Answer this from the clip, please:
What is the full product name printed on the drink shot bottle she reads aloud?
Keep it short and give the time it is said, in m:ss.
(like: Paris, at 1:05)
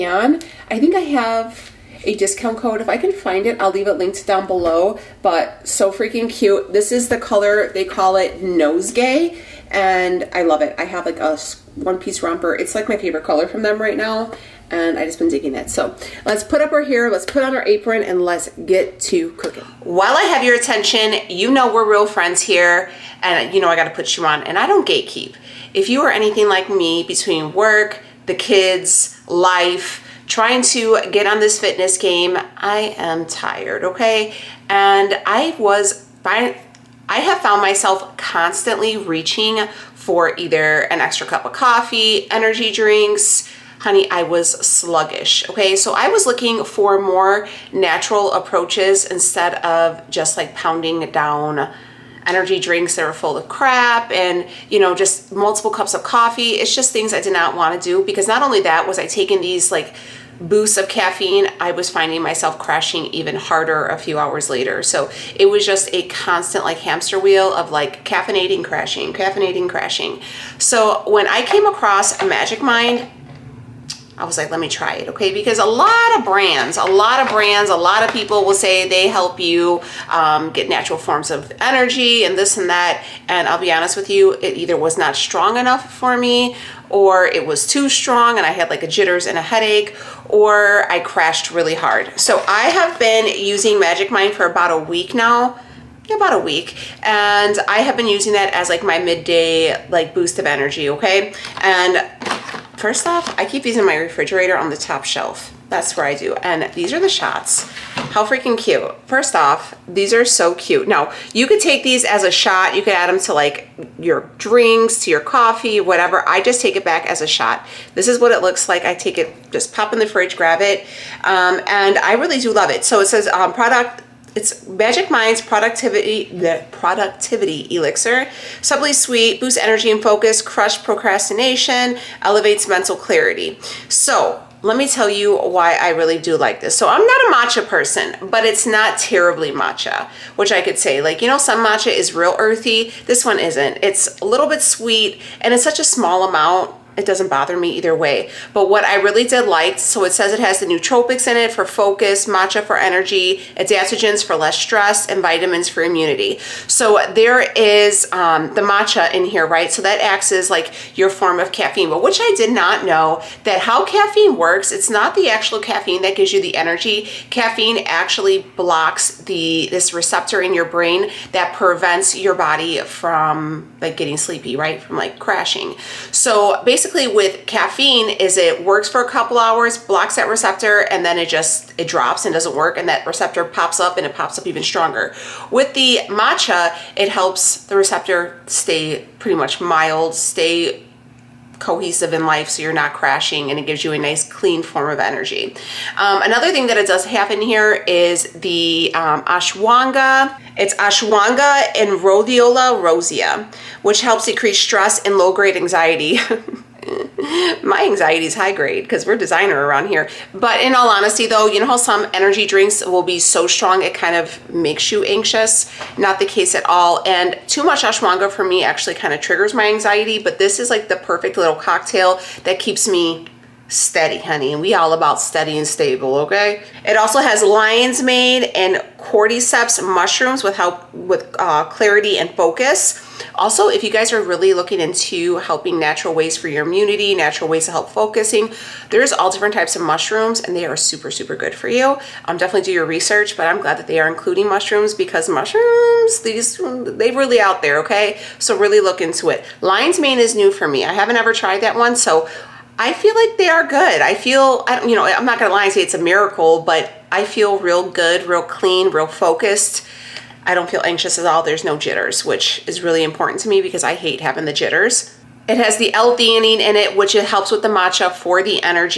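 Productivity Elixir, at 2:06.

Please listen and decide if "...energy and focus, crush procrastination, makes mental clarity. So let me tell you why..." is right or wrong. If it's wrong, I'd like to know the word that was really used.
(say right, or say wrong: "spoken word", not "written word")
wrong: "elevates", not "makes".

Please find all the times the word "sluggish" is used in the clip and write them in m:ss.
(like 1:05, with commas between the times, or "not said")
0:44.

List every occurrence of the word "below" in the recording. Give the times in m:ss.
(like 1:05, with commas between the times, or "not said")
0:04.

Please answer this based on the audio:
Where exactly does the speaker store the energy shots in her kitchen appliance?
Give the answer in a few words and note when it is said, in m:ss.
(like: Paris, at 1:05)
top shelf, at 1:44.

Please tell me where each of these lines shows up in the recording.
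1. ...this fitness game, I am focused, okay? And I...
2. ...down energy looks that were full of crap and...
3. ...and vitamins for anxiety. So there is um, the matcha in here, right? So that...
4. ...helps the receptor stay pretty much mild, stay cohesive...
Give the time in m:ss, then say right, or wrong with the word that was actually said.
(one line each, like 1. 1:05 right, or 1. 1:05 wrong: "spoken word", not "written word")
1. 0:31 wrong: "tired", not "focused"
2. 0:51 wrong: "drinks", not "looks"
3. 2:35 wrong: "immunity", not "anxiety"
4. 3:07 right.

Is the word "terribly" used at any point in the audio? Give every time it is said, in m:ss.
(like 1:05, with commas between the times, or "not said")
2:18.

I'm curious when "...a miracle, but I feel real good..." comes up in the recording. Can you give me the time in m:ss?
4:15.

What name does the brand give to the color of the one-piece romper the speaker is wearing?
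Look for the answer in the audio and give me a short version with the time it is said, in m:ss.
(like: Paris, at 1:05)
Nosegay, at 0:08.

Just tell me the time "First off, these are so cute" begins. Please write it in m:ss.
1:49.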